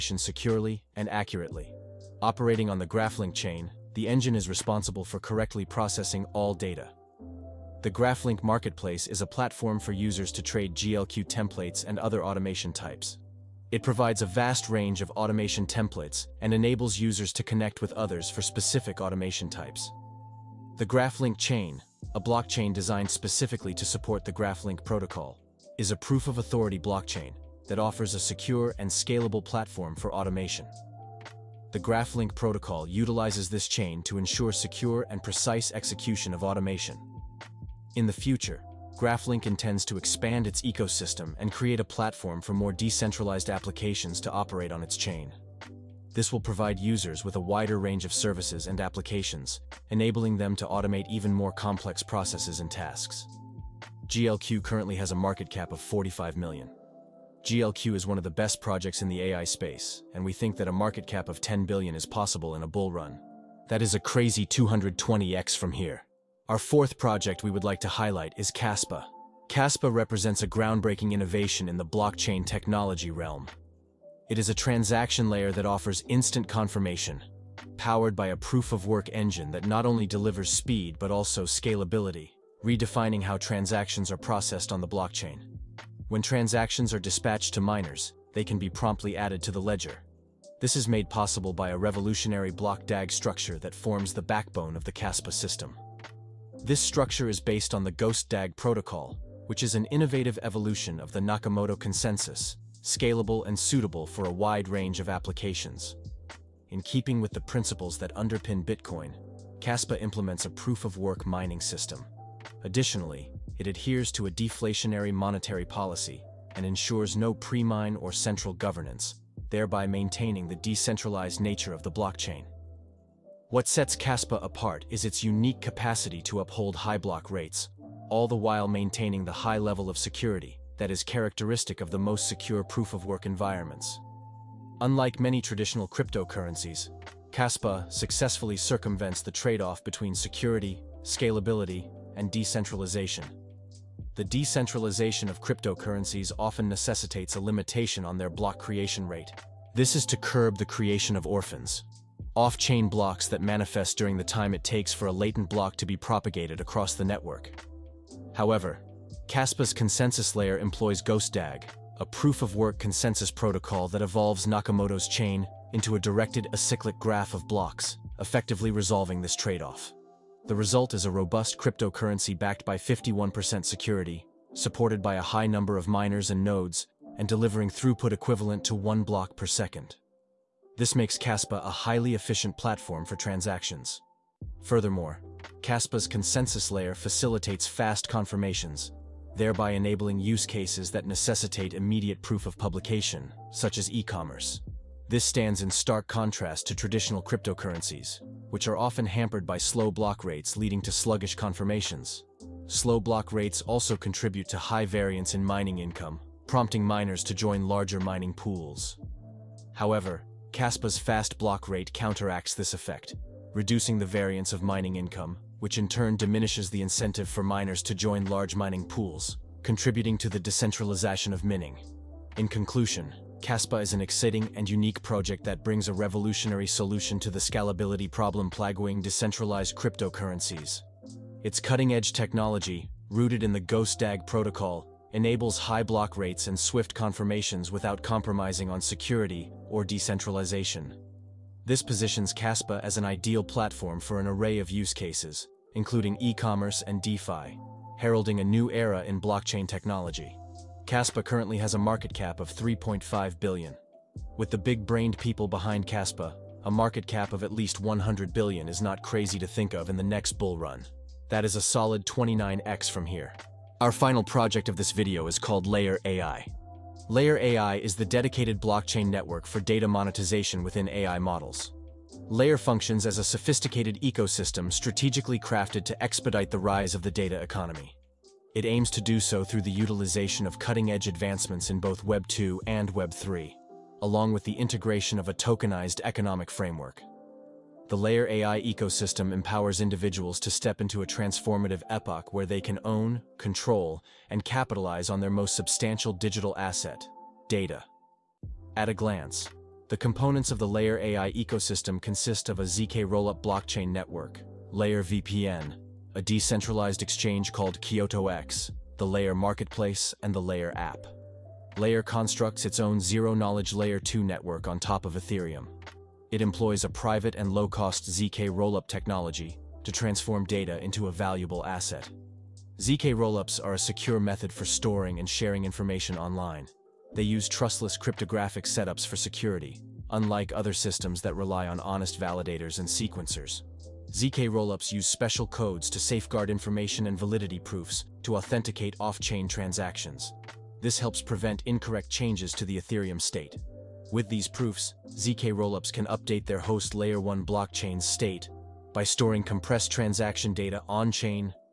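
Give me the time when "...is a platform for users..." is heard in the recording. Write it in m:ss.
0:09.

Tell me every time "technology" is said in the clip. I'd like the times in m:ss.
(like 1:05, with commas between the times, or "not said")
1:12, 3:52, 4:09, 5:18.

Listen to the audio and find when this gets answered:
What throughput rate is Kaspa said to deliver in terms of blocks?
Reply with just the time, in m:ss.
2:58.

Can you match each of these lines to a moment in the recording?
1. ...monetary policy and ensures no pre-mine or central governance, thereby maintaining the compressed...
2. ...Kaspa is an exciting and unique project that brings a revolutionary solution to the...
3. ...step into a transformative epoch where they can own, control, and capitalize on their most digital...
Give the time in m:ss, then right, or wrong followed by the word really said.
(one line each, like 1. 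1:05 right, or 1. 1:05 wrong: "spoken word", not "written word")
1. 1:55 wrong: "decentralized", not "compressed"
2. 3:43 right
3. 4:50 wrong: "substantial", not "digital".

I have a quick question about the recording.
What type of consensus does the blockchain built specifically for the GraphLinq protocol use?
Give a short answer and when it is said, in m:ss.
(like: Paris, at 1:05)
Proof of authority, at 0:25.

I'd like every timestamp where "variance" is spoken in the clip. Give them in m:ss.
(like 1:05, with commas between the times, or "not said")
3:24, 3:34.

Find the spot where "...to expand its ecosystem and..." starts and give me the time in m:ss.
0:39.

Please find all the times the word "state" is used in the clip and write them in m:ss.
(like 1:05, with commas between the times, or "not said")
5:43, 5:48.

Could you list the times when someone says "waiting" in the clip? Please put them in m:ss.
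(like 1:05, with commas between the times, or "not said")
not said.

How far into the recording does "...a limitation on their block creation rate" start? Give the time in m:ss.
2:27.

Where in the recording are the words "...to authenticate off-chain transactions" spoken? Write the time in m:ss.
5:38.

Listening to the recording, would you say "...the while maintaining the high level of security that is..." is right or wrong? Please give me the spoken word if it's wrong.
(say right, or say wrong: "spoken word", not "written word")
right.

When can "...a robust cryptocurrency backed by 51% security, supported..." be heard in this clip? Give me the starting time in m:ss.
2:51.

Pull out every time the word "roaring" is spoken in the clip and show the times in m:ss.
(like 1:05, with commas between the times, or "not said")
not said.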